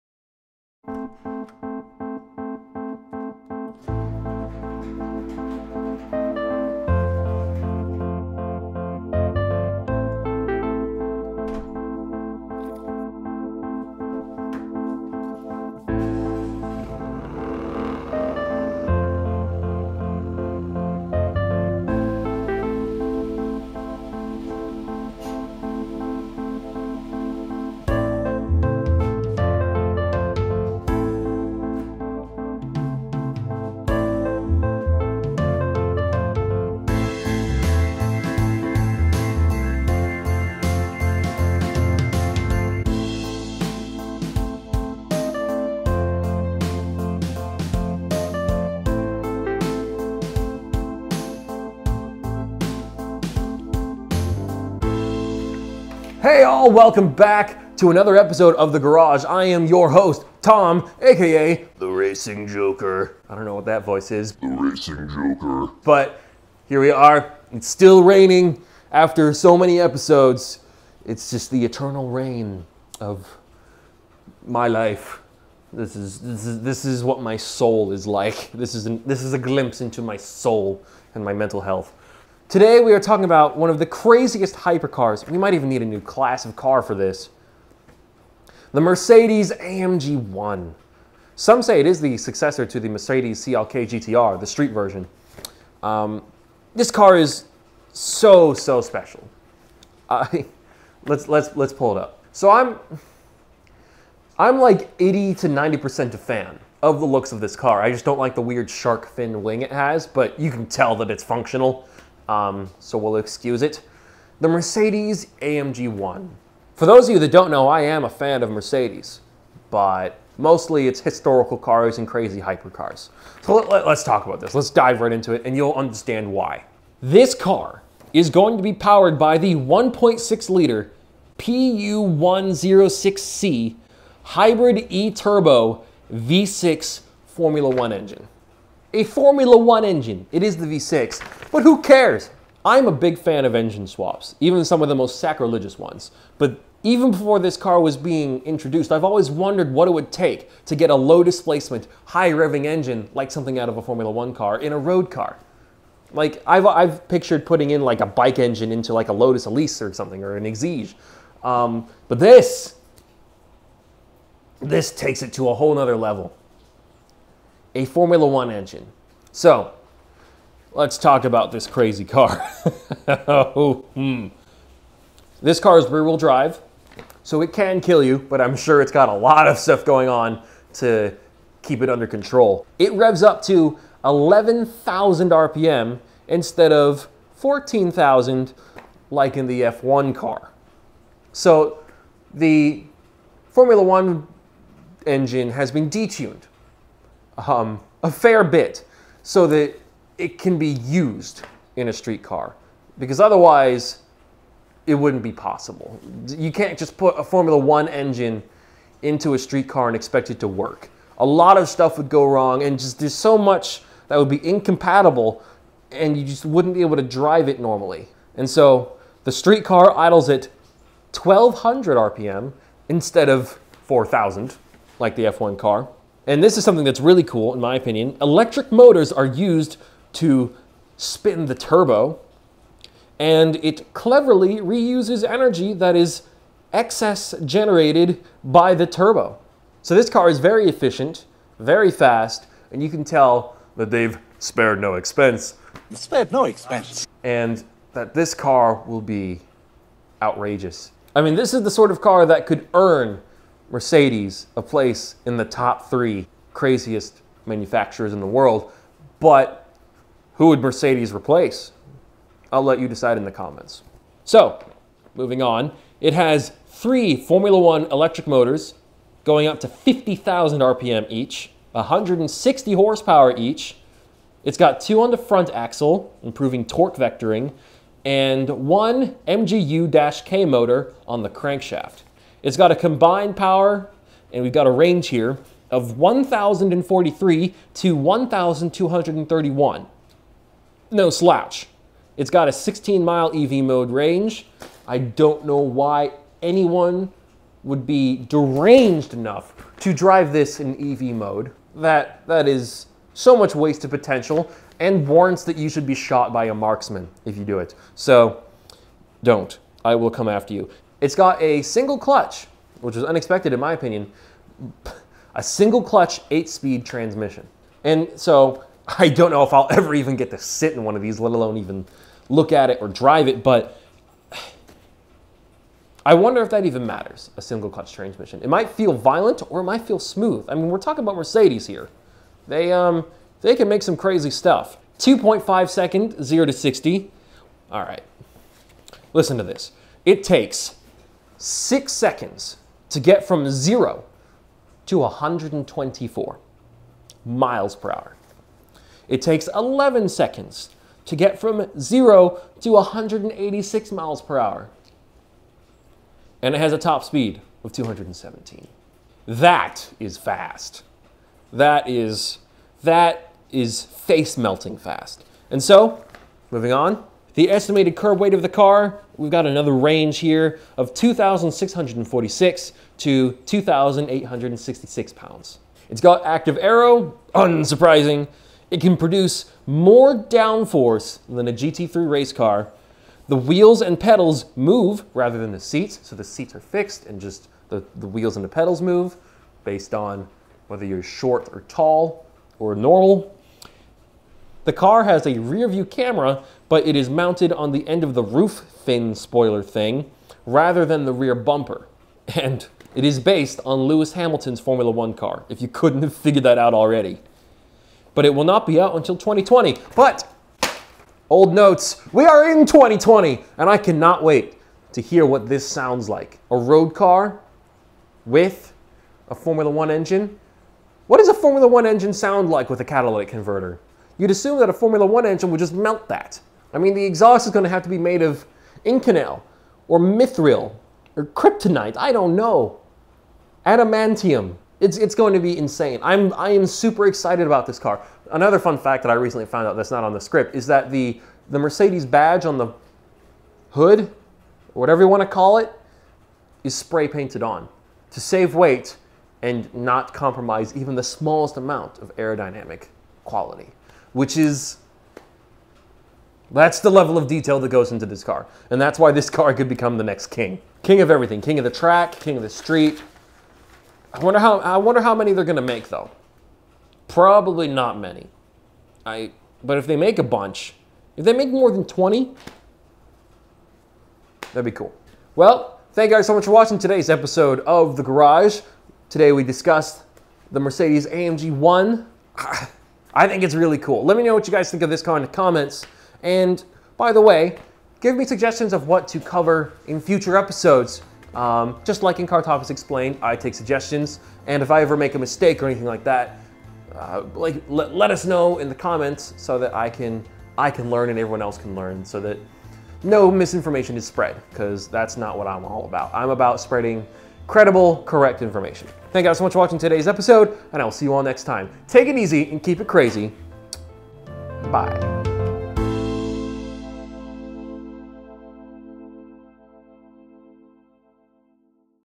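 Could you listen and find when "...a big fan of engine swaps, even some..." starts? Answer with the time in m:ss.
2:22.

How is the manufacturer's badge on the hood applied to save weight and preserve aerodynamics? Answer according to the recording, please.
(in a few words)
Spray painted.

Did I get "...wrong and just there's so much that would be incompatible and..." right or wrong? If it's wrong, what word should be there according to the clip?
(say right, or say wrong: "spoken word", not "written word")
right.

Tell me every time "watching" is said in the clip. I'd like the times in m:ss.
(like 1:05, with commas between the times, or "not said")
7:56, 8:29.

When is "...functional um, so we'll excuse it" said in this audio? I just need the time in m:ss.
1:51.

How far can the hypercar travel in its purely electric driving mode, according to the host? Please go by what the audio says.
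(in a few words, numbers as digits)
16 miles.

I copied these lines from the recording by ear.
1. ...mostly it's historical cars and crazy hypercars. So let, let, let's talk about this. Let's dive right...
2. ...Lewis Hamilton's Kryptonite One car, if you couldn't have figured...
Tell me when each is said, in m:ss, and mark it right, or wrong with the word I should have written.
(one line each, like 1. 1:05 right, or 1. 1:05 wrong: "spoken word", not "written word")
1. 2:00 right
2. 6:43 wrong: "Formula", not "Kryptonite".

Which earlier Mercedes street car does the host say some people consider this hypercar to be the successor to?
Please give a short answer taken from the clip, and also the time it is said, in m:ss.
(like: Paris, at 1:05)
Mercedes CLK GTR, at 1:32.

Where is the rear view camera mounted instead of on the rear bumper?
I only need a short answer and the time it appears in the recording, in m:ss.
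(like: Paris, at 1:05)
End of the roof fin spoiler, at 6:37.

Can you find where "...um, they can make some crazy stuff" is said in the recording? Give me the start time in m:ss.
5:32.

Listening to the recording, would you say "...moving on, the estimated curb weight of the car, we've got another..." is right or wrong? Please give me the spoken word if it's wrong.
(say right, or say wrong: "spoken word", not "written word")
right.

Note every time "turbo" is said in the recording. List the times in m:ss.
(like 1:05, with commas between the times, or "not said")
2:14, 3:51, 3:58.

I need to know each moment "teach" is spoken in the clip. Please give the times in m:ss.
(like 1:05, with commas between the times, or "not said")
not said.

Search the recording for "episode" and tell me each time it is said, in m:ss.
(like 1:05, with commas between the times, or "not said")
0:58, 1:09, 7:57, 8:10, 8:30.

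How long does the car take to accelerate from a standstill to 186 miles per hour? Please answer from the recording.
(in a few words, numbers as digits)
11 seconds.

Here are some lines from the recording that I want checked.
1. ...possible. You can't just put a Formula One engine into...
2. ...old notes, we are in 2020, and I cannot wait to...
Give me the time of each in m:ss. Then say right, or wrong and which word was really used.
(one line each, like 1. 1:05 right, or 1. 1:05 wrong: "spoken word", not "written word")
1. 3:25 right
2. 6:51 right.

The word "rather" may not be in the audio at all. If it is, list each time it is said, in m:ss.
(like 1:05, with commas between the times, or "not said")
6:25, 6:40.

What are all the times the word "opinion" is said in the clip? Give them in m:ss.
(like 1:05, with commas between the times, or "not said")
3:47, 5:13.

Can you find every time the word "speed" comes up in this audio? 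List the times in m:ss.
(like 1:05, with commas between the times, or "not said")
5:16, 5:57.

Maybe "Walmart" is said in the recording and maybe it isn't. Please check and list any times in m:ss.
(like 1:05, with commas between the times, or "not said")
not said.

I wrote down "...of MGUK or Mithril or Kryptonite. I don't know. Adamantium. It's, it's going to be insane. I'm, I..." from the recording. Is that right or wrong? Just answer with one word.
wrong.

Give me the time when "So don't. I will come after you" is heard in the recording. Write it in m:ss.
5:07.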